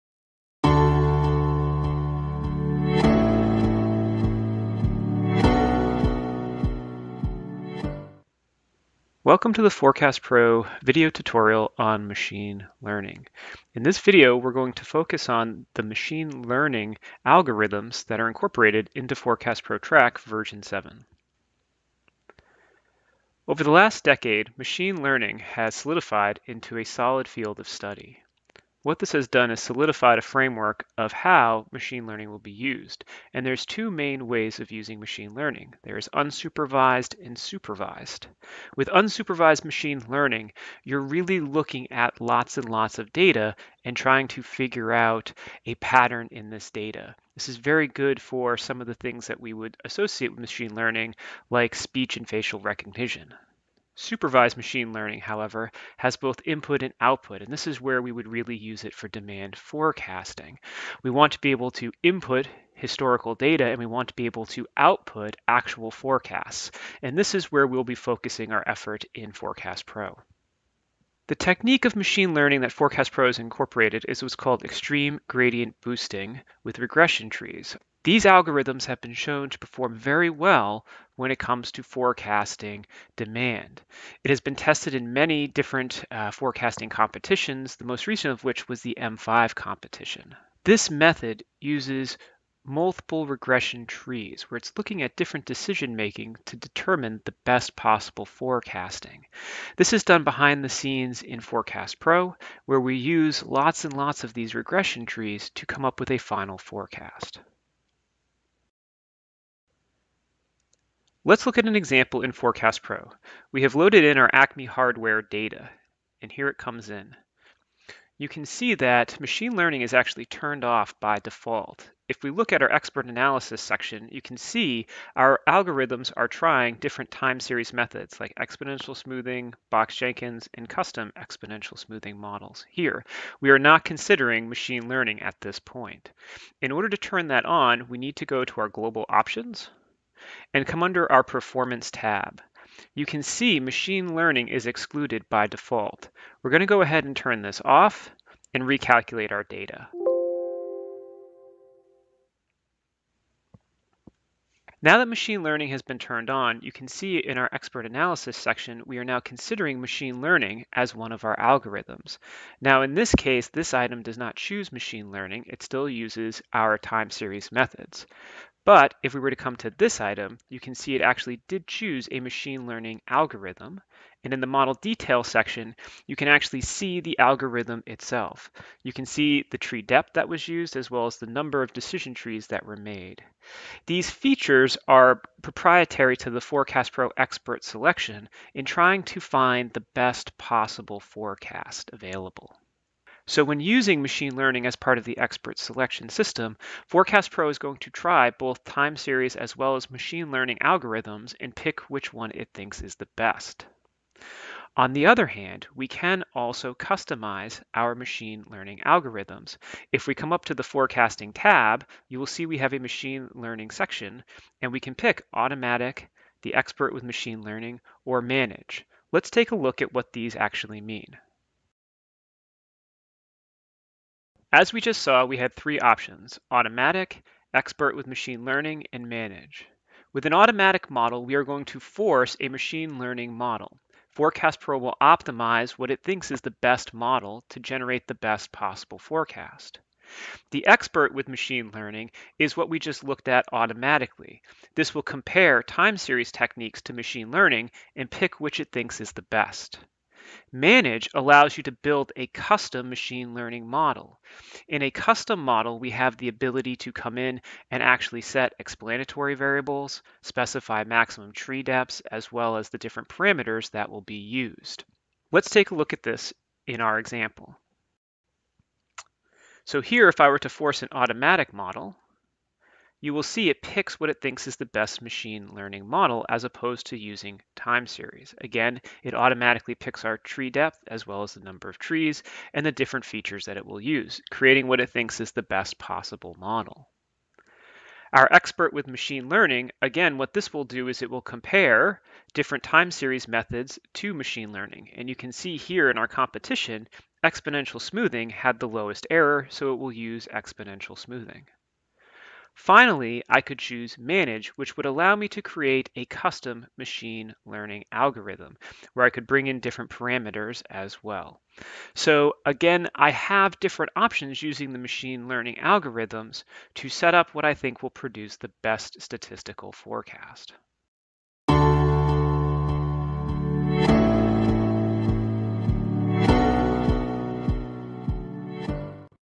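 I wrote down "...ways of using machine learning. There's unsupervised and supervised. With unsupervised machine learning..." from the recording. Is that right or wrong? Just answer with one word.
right.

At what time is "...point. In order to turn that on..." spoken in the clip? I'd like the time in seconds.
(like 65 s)
135 s.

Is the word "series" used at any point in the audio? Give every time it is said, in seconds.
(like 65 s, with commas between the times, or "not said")
127 s, 167 s, 198 s, 245 s, 277 s, 292 s.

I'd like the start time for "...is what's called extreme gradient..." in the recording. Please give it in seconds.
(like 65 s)
74 s.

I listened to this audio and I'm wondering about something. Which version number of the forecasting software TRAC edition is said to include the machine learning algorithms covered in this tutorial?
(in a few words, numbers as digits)
7.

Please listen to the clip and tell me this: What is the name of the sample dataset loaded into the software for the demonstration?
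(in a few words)
Acme hardware.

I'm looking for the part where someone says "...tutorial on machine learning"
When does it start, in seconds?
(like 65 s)
11 s.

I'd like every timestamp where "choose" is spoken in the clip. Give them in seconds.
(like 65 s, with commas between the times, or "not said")
164 s, 171 s, 303 s.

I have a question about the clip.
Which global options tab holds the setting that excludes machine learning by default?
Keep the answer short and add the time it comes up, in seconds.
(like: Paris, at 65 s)
Performance, at 141 s.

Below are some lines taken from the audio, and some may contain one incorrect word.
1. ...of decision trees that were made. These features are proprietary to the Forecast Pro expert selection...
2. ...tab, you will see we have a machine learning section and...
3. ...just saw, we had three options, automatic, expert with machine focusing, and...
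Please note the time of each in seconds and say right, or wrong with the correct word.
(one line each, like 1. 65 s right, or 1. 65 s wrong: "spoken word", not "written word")
1. 181 s right
2. 211 s right
3. 224 s wrong: "learning", not "focusing".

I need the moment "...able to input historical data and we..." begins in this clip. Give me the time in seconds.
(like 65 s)
61 s.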